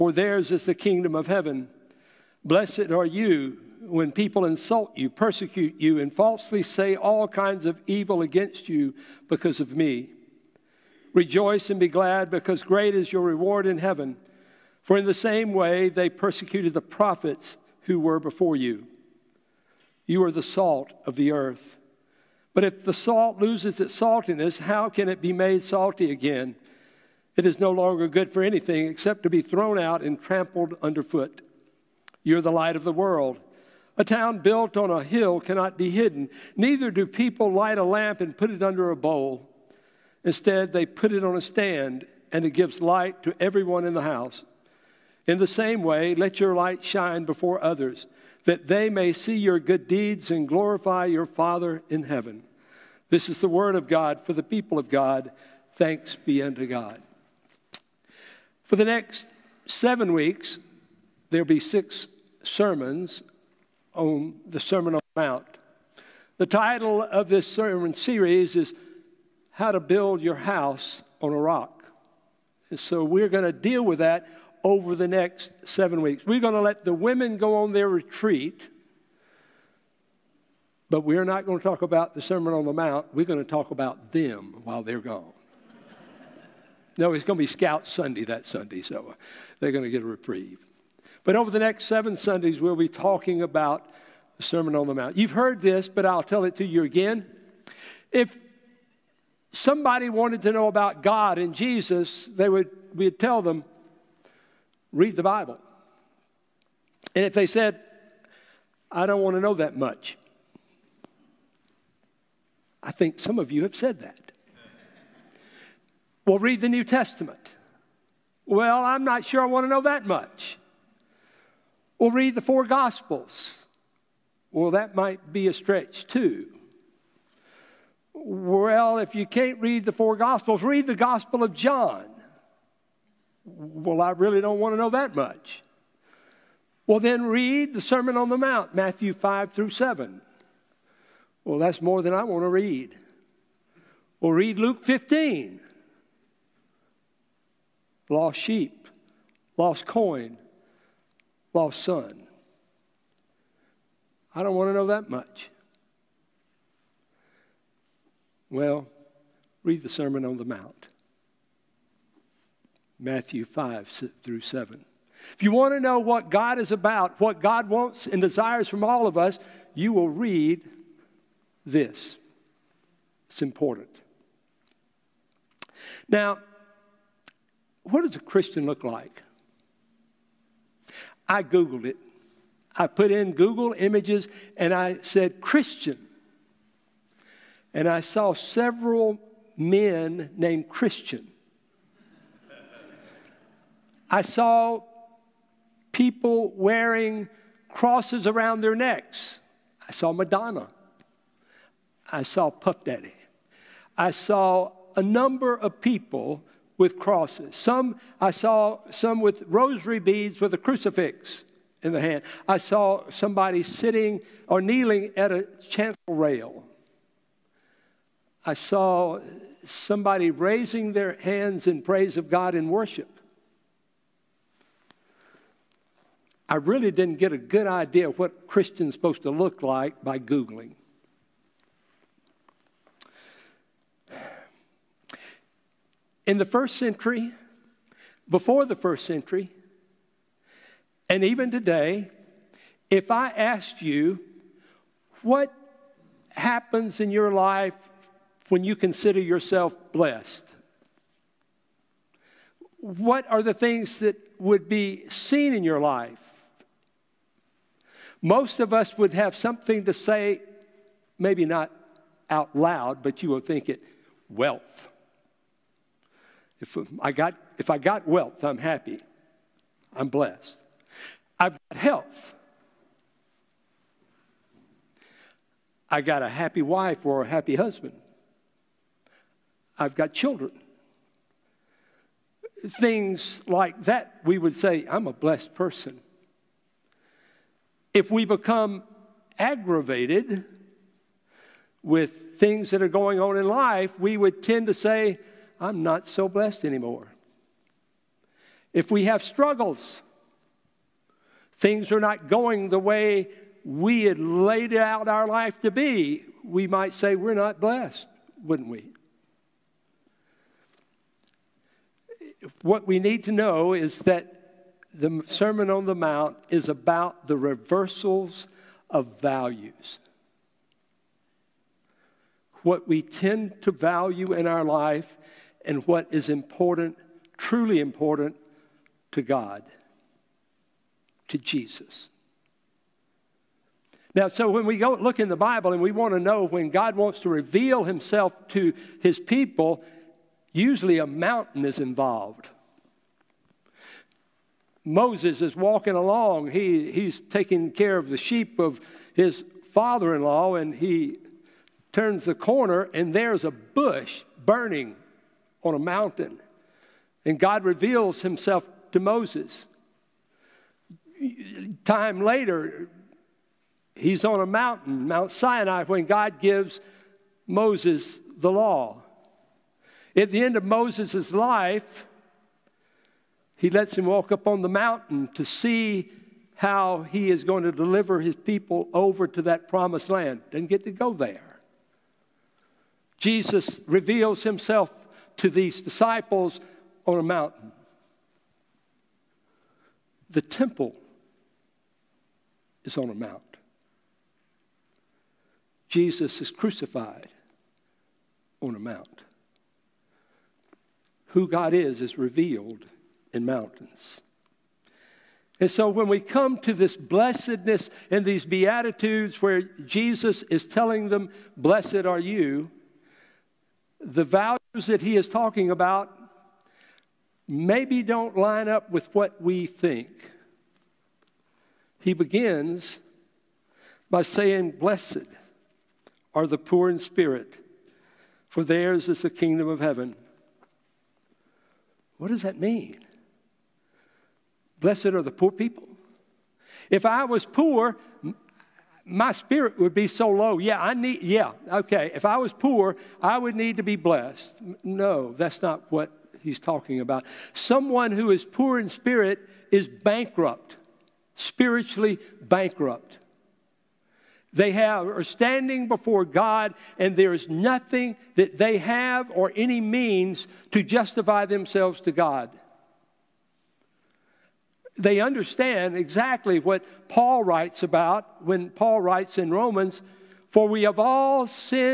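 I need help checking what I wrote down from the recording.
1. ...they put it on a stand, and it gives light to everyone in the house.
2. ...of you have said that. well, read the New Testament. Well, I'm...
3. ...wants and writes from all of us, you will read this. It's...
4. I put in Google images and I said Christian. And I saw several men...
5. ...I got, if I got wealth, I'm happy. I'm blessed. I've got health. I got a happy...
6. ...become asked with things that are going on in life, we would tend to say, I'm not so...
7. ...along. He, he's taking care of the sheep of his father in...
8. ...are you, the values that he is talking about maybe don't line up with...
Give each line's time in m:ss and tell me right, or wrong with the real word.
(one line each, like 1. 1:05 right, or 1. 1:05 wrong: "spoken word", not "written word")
1. 0:40 right
2. 1:53 right
3. 2:47 wrong: "desires", not "writes"
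4. 3:02 right
5. 4:26 right
6. 4:48 wrong: "aggravated", not "asked"
7. 5:45 right
8. 6:52 right.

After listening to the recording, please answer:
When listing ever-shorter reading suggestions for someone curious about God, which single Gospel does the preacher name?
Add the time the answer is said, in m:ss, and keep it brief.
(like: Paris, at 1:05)
Gospel of John, at 2:10.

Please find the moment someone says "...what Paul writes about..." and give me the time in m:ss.
7:46.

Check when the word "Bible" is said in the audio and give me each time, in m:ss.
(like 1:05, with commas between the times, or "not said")
1:45, 5:35.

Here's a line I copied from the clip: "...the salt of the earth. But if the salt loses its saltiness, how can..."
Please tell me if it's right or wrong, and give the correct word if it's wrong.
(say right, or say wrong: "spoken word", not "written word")
right.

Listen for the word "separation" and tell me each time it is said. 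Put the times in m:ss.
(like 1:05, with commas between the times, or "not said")
not said.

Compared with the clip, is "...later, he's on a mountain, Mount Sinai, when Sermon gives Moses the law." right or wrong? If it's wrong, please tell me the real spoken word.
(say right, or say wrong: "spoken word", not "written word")
wrong: "God", not "Sermon".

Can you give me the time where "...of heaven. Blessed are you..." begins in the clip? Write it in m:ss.
0:01.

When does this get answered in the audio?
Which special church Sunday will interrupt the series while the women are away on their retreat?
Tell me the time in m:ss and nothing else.
1:27.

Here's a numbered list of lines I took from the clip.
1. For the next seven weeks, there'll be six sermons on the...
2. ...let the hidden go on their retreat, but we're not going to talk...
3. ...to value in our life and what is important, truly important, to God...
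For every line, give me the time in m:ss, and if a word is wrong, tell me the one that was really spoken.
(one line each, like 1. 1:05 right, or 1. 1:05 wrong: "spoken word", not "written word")
1. 0:58 right
2. 1:16 wrong: "women", not "hidden"
3. 5:23 right.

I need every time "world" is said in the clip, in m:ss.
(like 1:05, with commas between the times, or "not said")
0:32.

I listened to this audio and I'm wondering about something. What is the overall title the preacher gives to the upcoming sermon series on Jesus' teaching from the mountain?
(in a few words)
How to Build Your House on a Rock.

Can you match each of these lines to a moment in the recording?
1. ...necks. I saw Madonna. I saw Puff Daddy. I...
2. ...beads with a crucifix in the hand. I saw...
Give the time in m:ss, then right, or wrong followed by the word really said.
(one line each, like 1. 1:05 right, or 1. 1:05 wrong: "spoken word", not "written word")
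1. 3:18 right
2. 3:29 right.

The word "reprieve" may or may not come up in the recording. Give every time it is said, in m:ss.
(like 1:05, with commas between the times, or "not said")
1:30.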